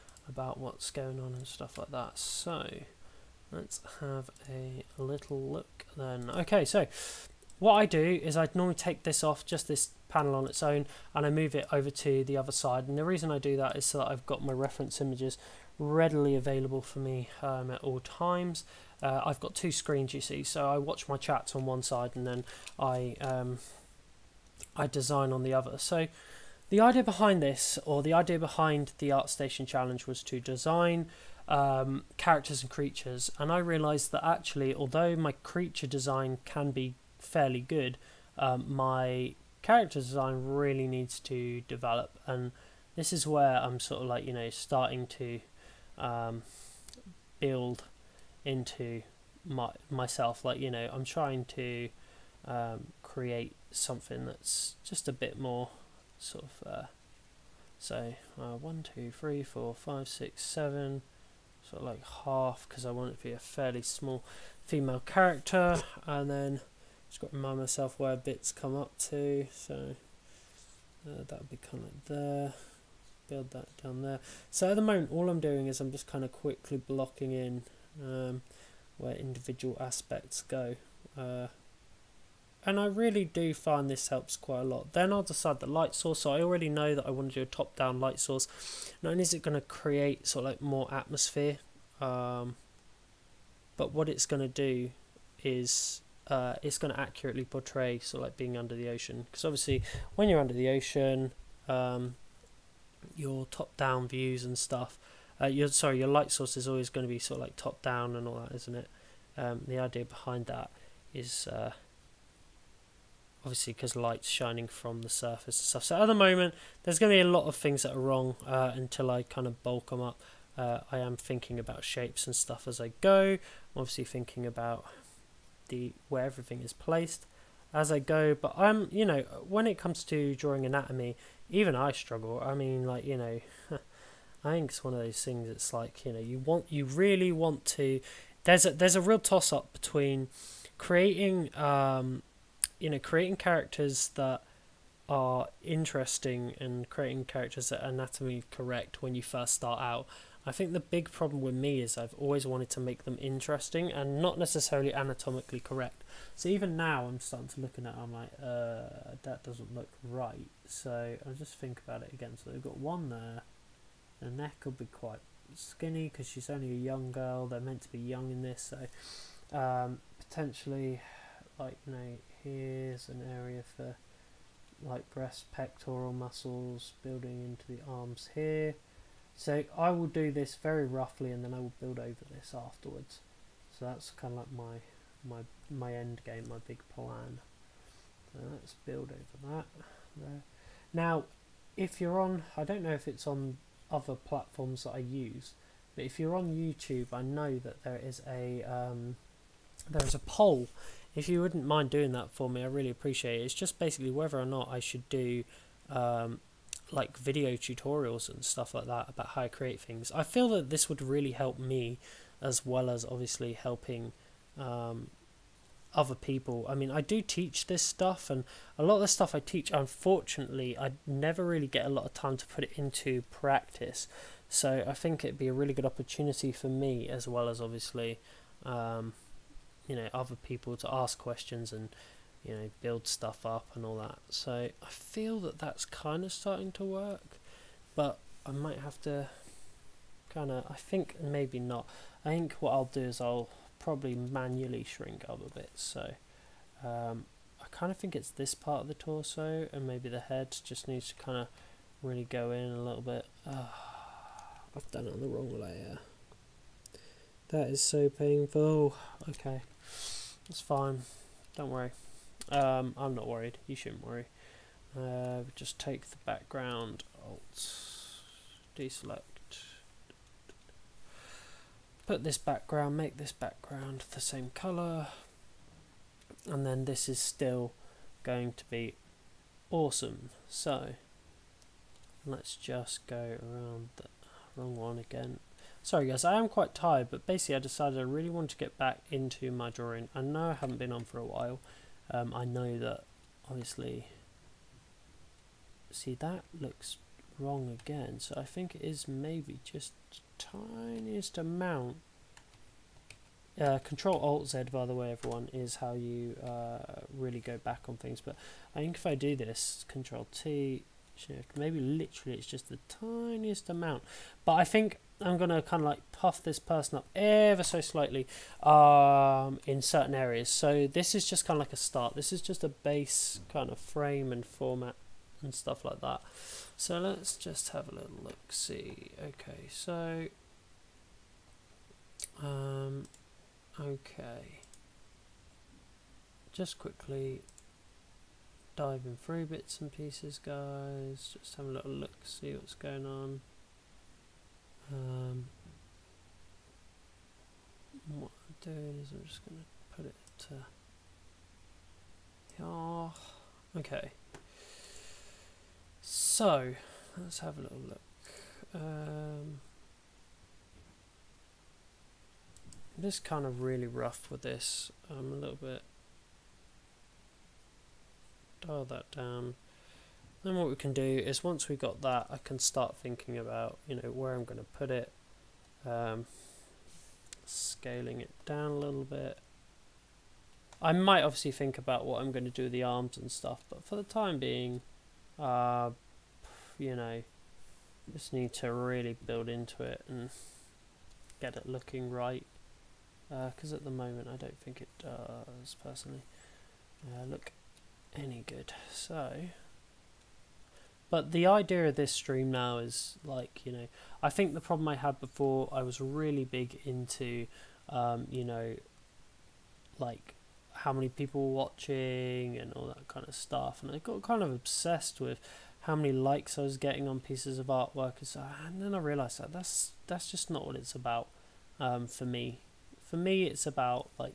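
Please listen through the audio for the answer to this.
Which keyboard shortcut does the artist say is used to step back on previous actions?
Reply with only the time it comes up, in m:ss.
5:03.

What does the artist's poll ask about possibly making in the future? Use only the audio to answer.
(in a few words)
Video tutorials.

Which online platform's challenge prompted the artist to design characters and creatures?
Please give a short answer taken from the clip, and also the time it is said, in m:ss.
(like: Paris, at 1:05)
ArtStation, at 0:29.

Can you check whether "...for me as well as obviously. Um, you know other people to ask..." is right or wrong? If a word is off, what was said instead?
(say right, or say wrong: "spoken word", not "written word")
right.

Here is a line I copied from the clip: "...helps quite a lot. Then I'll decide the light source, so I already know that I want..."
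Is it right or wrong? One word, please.
right.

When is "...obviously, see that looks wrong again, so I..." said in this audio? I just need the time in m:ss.
4:53.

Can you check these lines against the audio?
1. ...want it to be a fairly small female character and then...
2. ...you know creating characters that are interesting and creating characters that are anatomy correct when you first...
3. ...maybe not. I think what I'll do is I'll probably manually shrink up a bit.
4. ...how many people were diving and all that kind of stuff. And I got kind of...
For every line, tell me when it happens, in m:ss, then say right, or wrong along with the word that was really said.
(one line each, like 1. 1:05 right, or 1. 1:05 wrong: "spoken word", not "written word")
1. 1:02 right
2. 2:22 right
3. 4:01 right
4. 6:50 wrong: "watching", not "diving".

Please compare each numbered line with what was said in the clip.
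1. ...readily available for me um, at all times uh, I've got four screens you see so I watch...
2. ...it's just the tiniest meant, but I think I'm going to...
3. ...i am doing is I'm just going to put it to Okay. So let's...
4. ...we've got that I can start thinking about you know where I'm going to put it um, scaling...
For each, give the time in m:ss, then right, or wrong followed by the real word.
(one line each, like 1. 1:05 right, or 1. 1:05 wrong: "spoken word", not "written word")
1. 0:15 wrong: "two", not "four"
2. 5:12 wrong: "amount", not "meant"
3. 5:48 right
4. 6:11 right.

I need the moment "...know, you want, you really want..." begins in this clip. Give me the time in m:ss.
2:16.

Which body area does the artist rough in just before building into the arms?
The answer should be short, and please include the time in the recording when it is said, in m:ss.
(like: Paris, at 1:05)
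Pectoral muscles, at 2:55.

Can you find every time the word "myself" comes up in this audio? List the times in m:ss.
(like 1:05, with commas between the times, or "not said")
0:49, 1:07.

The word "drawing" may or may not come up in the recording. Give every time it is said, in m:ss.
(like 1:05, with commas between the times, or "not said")
2:10, 4:49.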